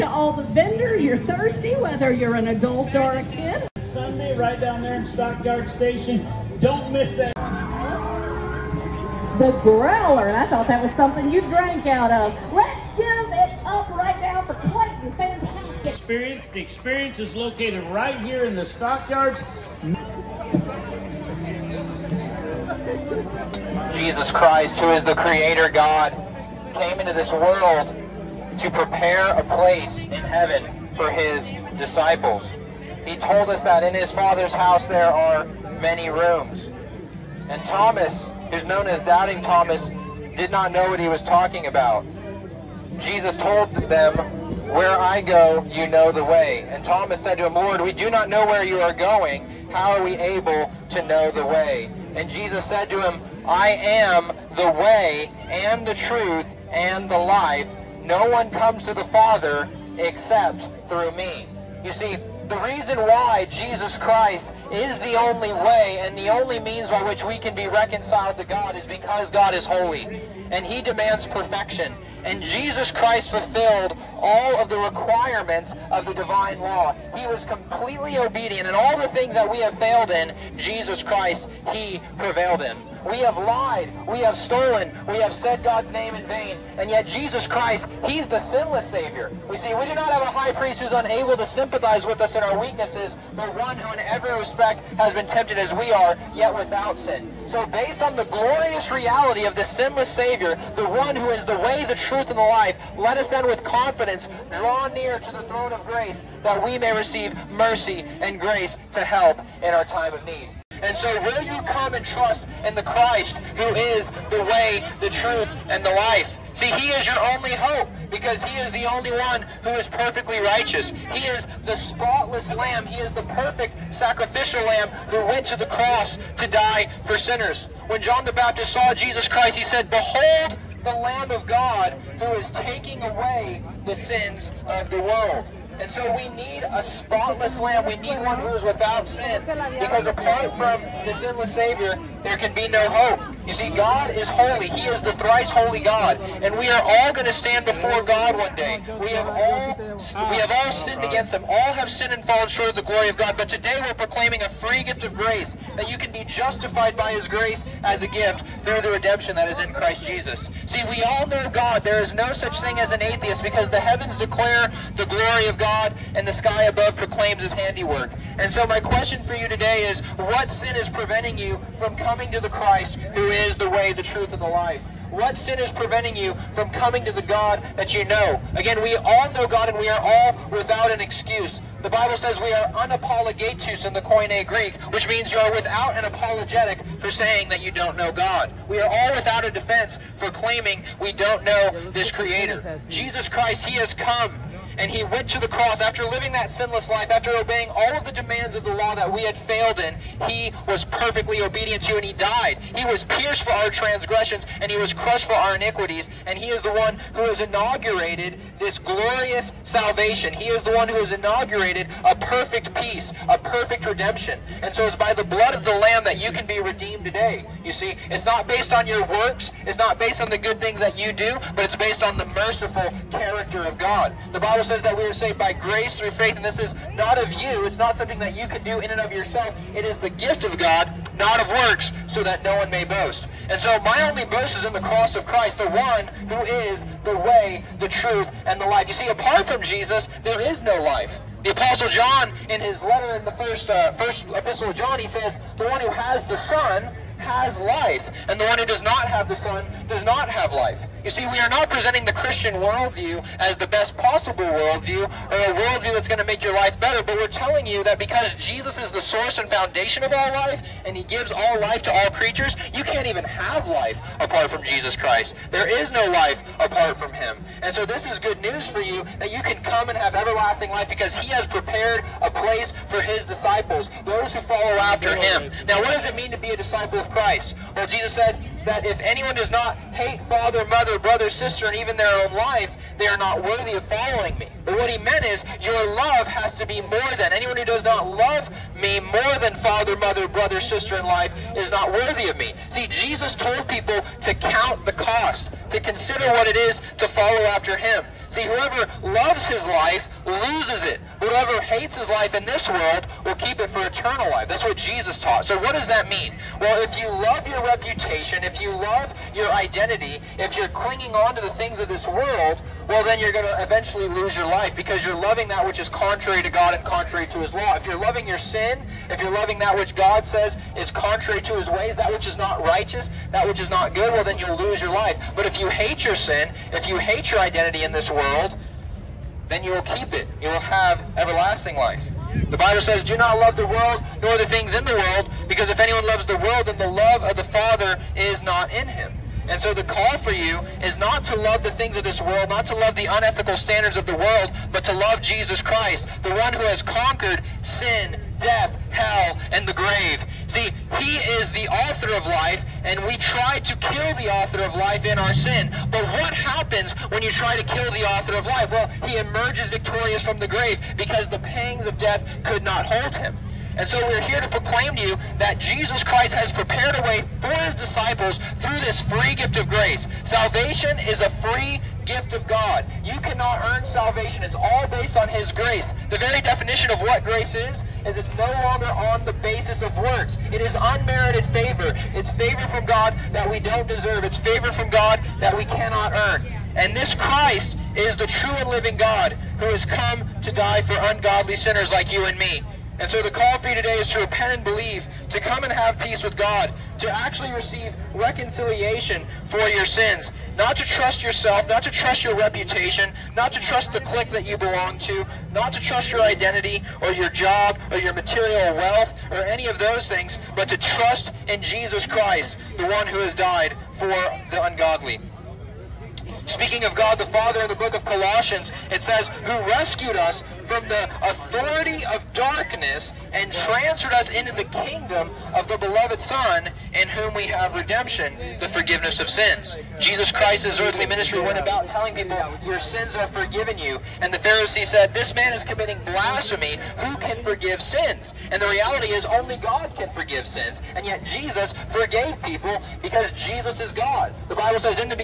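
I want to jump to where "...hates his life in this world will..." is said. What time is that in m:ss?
5:01.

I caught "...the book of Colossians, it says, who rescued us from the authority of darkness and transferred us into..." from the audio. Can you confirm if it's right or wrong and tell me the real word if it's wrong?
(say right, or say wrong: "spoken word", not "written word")
right.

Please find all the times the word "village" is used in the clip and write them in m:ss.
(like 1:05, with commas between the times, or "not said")
not said.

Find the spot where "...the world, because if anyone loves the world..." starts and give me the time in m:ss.
5:34.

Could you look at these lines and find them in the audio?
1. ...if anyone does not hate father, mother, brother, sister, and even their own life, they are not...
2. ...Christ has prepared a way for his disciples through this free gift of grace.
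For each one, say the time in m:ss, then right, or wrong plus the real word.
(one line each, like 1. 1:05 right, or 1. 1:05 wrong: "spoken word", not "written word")
1. 4:38 right
2. 6:06 right.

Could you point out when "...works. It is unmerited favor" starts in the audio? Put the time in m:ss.
6:19.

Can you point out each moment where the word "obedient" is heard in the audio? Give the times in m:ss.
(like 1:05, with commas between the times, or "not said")
1:18, 3:21.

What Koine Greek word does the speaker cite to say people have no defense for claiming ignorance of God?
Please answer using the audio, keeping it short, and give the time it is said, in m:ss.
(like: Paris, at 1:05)
anapologetous, at 3:02.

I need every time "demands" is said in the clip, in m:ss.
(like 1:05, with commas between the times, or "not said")
1:10, 3:18.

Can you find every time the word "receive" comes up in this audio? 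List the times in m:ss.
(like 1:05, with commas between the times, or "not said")
1:46, 6:37.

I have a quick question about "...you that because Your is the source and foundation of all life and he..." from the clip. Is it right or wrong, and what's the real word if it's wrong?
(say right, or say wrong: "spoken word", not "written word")
wrong: "Jesus", not "Your".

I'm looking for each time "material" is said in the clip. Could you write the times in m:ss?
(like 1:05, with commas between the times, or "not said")
6:48.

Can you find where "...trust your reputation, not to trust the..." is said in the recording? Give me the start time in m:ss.
6:41.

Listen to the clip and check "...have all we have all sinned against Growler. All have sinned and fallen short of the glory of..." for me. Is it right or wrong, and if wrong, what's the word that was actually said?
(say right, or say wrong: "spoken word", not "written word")
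wrong: "Him", not "Growler".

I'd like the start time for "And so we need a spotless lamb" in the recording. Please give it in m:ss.
2:15.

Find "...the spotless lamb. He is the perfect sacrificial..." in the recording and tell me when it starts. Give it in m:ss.
2:01.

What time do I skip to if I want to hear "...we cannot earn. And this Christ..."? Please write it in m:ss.
6:25.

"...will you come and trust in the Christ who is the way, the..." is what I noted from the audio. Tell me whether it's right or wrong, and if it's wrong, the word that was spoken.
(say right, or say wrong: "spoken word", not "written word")
right.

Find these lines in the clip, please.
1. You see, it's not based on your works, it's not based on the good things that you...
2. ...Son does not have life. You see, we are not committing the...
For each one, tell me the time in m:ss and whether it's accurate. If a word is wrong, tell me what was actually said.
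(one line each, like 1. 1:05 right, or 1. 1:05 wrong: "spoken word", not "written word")
1. 3:37 right
2. 4:09 wrong: "presenting", not "committing".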